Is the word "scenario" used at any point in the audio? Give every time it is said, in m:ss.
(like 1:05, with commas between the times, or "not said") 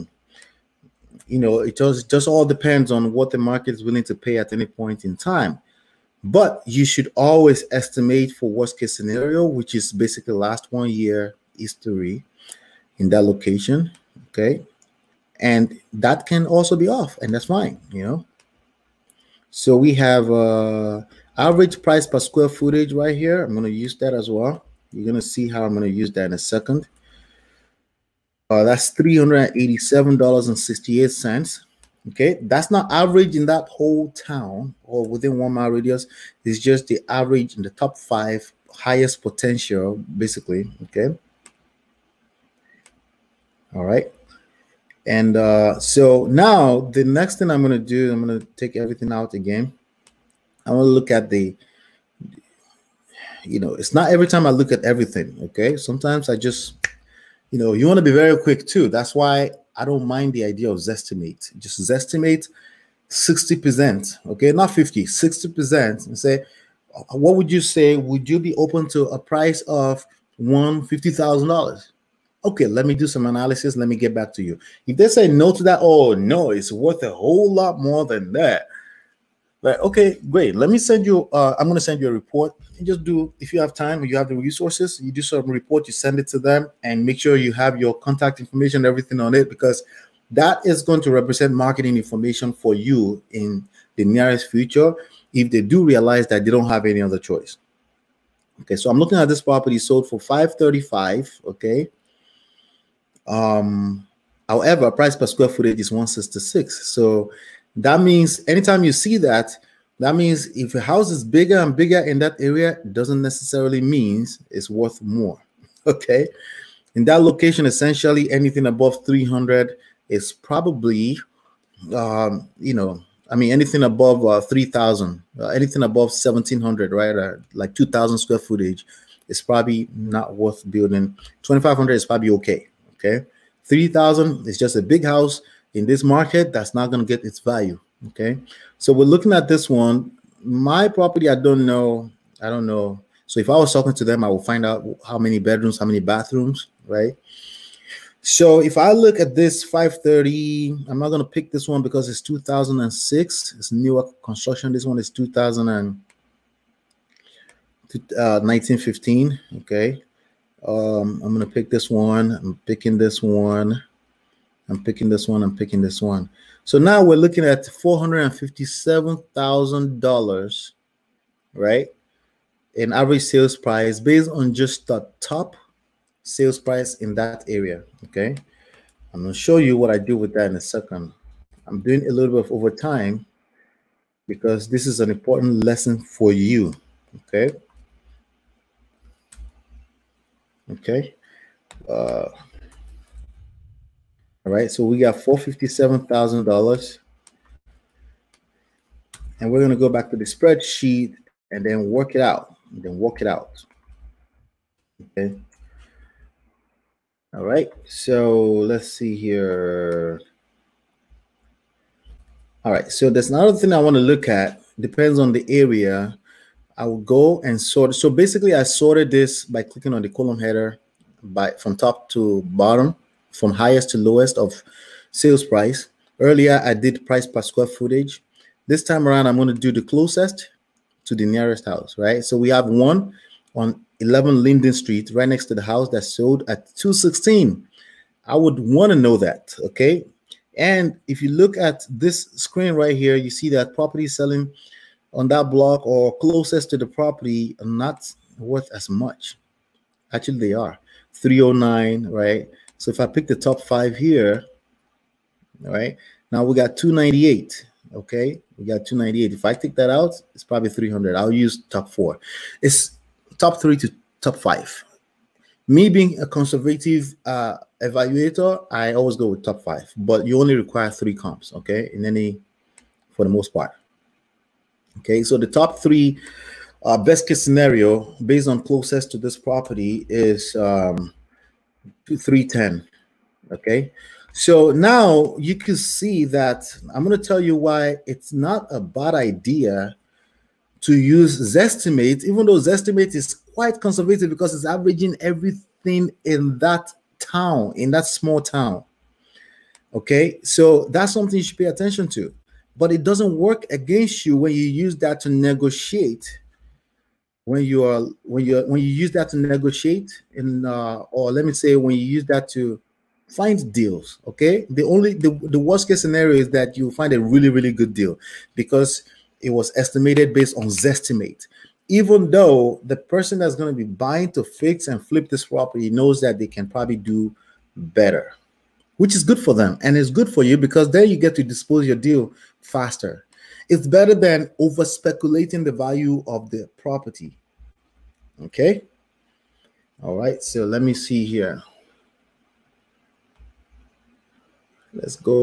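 0:08, 4:37, 5:16.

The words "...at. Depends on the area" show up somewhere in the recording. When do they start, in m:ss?
3:34.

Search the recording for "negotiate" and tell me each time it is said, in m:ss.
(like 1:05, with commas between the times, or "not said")
5:05, 5:09.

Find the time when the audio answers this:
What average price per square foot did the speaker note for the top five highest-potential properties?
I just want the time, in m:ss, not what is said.
0:28.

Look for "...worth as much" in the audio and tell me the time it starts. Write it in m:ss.
4:08.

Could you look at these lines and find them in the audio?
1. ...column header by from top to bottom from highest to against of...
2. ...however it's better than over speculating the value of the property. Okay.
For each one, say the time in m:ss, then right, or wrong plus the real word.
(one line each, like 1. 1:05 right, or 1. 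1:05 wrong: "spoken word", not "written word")
1. 3:40 wrong: "lowest", not "against"
2. 5:32 wrong: "faster", not "however".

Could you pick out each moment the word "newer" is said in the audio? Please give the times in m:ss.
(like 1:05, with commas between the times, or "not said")
2:33.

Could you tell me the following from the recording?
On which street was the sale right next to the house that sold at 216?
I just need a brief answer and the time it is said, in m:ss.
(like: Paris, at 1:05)
Linden Street, at 3:54.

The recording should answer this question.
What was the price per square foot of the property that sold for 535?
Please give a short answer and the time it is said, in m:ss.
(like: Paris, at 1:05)
166, at 1:45.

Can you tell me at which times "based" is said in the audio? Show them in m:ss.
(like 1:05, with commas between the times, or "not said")
2:53, 4:38, 5:20.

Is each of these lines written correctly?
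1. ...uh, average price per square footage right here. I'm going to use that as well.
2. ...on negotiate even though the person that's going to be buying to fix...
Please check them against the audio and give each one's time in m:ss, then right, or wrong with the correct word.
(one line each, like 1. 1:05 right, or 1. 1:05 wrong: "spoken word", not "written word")
1. 0:20 right
2. 5:20 wrong: "zestimate", not "negotiate".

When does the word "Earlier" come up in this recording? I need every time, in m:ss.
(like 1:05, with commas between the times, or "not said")
3:46.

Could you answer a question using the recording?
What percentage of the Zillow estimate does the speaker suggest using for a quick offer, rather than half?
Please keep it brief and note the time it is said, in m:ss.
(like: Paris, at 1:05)
60%, at 1:03.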